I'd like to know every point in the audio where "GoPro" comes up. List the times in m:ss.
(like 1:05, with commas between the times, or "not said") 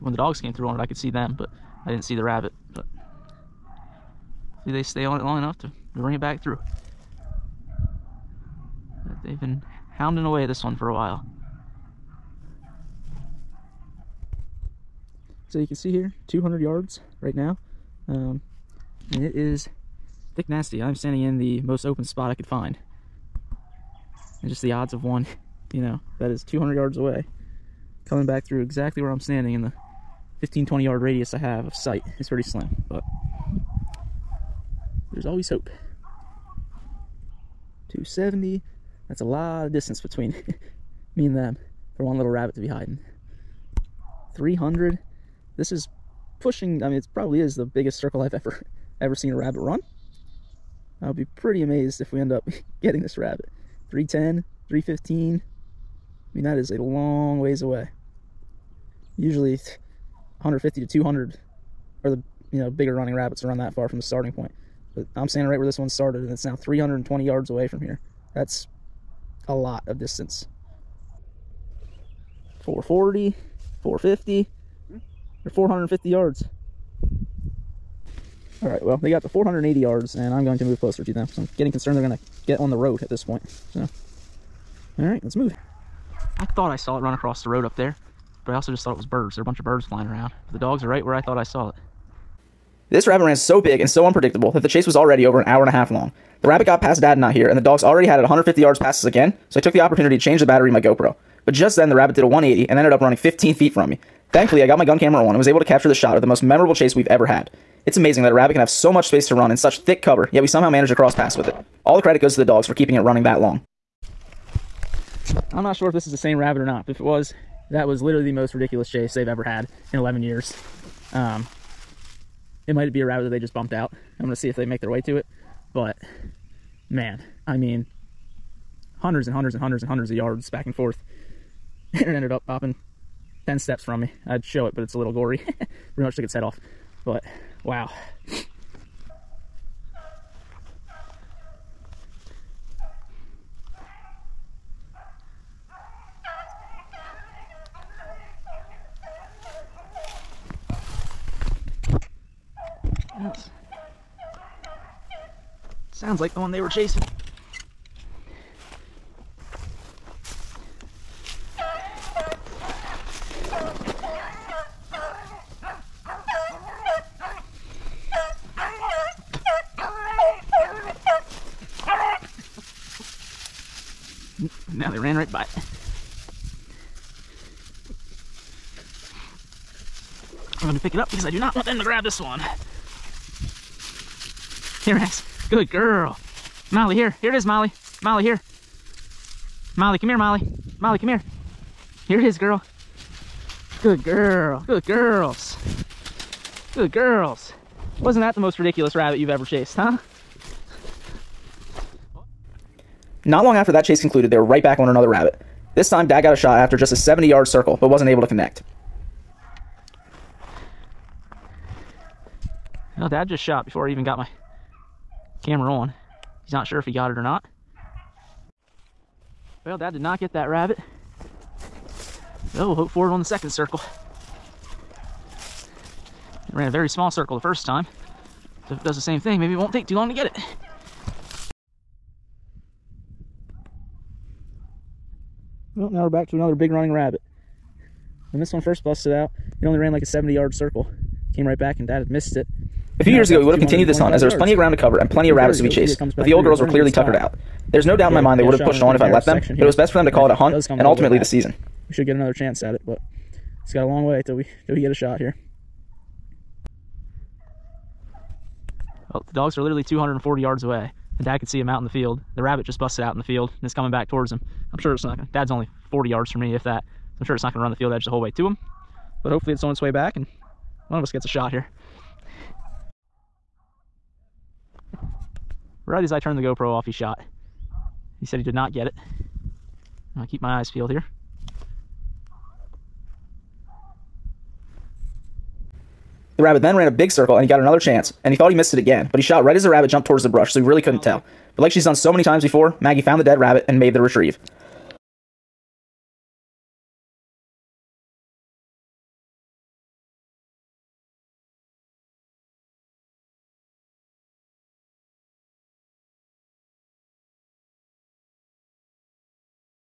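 1:40, 4:36.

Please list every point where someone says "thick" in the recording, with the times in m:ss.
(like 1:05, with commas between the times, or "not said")
0:20, 1:49.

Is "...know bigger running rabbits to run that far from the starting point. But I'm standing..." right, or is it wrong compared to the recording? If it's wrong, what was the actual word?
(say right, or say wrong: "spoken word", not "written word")
right.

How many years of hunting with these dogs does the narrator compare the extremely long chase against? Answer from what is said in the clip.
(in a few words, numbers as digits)
11.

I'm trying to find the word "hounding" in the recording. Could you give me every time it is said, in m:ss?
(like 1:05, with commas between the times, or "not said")
0:09.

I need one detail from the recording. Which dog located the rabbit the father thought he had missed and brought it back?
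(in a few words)
Maggie.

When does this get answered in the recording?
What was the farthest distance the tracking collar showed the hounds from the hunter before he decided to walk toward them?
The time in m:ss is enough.
1:19.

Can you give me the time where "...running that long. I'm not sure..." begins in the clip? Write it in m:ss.
1:52.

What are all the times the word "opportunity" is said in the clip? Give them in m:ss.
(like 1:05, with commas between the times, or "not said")
1:39.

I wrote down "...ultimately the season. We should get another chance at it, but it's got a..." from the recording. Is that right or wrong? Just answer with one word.
right.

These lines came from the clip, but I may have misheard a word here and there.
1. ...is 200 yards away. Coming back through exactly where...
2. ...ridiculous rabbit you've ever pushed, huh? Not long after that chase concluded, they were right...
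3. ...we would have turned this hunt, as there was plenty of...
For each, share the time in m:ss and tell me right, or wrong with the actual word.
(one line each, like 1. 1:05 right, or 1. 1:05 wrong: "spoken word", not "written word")
1. 0:26 right
2. 3:18 wrong: "chased", not "pushed"
3. 4:03 wrong: "continued", not "turned".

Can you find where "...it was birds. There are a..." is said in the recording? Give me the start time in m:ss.
1:28.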